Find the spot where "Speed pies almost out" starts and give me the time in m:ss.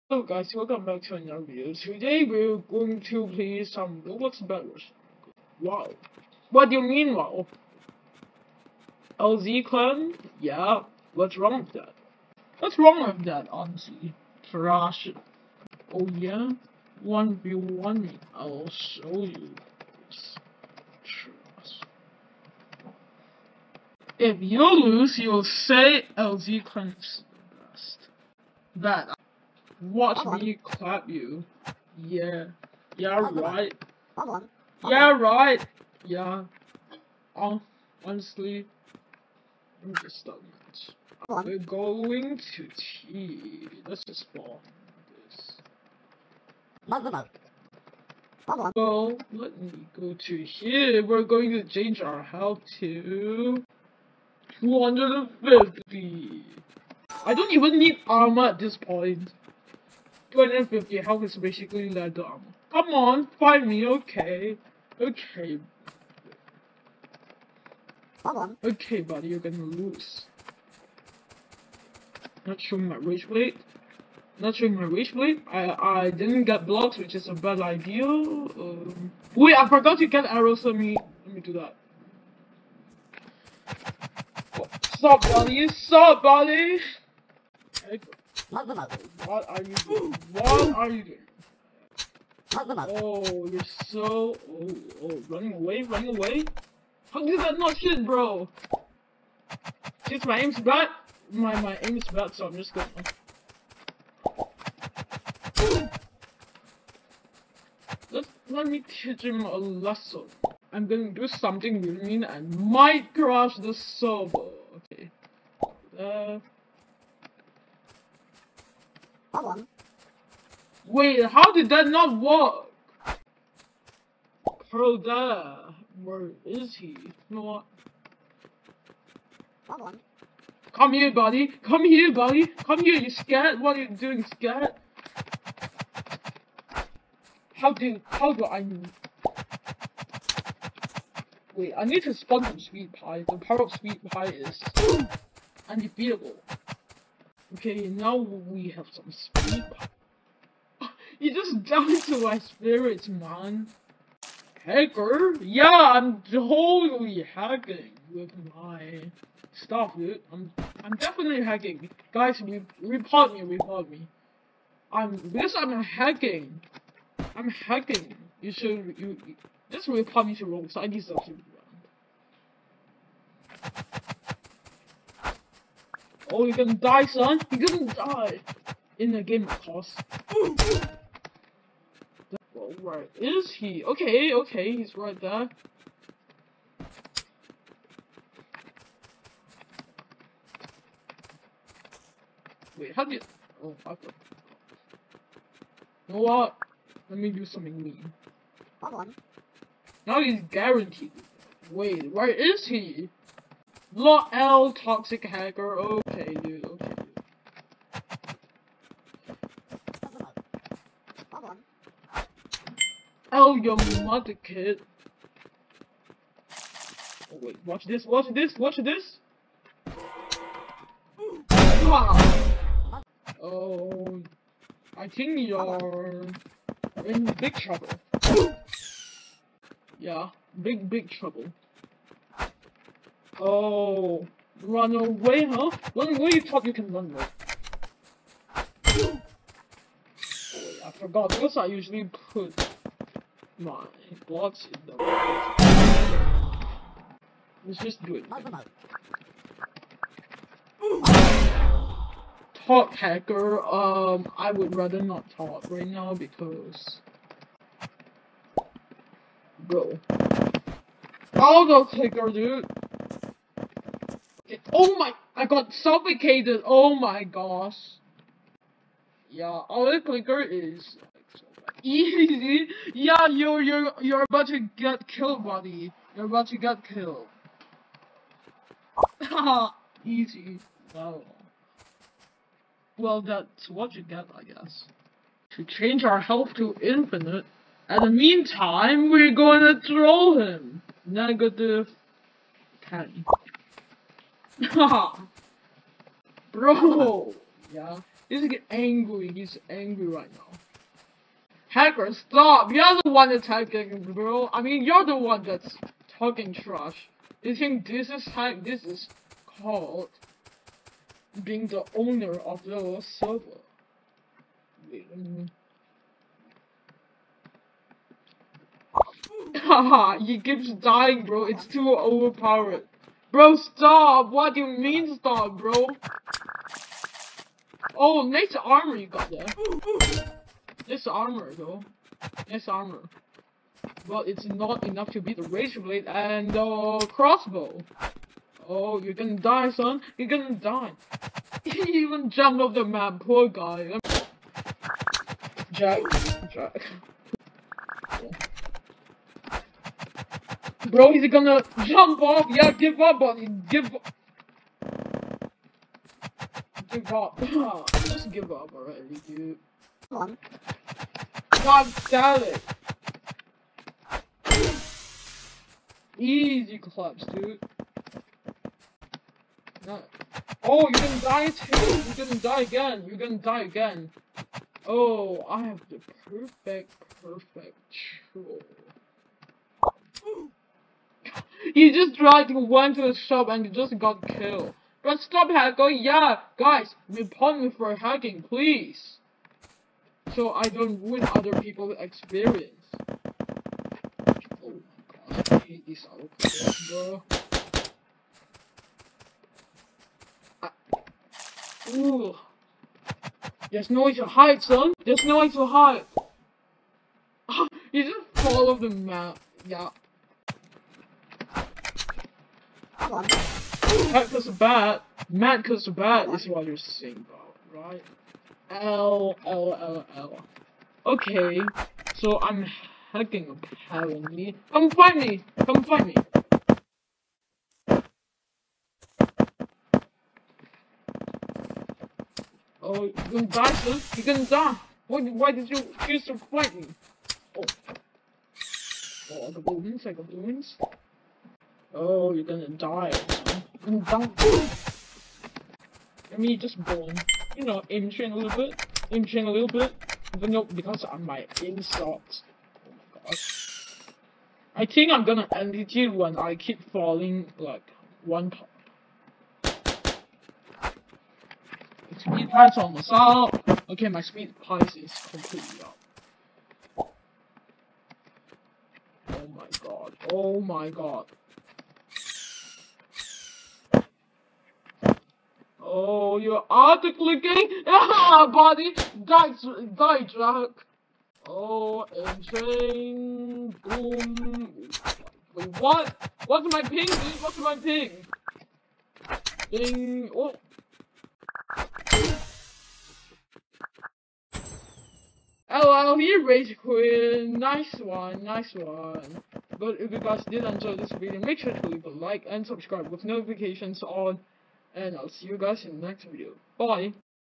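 7:42.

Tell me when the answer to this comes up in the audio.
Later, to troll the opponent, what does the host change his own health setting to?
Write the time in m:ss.
4:46.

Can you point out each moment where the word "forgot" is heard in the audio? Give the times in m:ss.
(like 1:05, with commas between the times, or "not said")
1:19, 4:00.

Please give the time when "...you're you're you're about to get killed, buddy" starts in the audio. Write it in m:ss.
4:33.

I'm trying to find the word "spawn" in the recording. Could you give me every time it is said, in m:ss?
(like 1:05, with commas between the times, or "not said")
0:44, 2:22.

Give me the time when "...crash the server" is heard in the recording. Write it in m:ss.
1:53.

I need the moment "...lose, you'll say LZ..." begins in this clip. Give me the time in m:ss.
0:24.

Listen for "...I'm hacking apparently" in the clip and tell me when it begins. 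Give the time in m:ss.
7:02.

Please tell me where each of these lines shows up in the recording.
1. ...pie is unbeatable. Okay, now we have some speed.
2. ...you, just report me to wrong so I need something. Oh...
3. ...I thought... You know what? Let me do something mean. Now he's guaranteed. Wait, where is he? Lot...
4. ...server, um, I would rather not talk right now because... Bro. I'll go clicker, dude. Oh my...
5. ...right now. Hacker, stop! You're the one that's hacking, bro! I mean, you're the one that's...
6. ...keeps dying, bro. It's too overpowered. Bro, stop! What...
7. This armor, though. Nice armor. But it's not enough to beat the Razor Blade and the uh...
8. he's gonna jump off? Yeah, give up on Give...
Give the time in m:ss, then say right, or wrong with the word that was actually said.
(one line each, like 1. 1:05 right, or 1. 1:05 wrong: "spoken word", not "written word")
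1. 2:24 right
2. 2:48 right
3. 3:13 right
4. 4:12 wrong: "hacker", not "server"
5. 5:00 right
6. 5:20 right
7. 5:30 right
8. 5:51 right.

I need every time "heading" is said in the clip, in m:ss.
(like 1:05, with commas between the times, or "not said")
not said.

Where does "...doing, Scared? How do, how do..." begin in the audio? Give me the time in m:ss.
2:13.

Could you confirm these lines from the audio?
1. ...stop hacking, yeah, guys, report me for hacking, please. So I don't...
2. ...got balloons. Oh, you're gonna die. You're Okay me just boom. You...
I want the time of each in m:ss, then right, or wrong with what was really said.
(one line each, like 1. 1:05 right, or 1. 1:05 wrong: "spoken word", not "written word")
1. 6:25 right
2. 7:20 wrong: "Let", not "Okay".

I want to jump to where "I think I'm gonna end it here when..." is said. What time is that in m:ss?
7:34.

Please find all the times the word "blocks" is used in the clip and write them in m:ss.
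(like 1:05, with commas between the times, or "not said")
1:16, 4:04.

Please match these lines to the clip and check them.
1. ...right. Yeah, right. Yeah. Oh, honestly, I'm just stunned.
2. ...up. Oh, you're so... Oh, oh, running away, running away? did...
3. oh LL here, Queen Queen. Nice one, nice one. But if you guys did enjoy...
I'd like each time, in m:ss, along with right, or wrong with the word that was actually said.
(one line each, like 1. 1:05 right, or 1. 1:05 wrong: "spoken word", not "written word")
1. 0:33 right
2. 1:32 right
3. 8:15 wrong: "Rage", not "Queen".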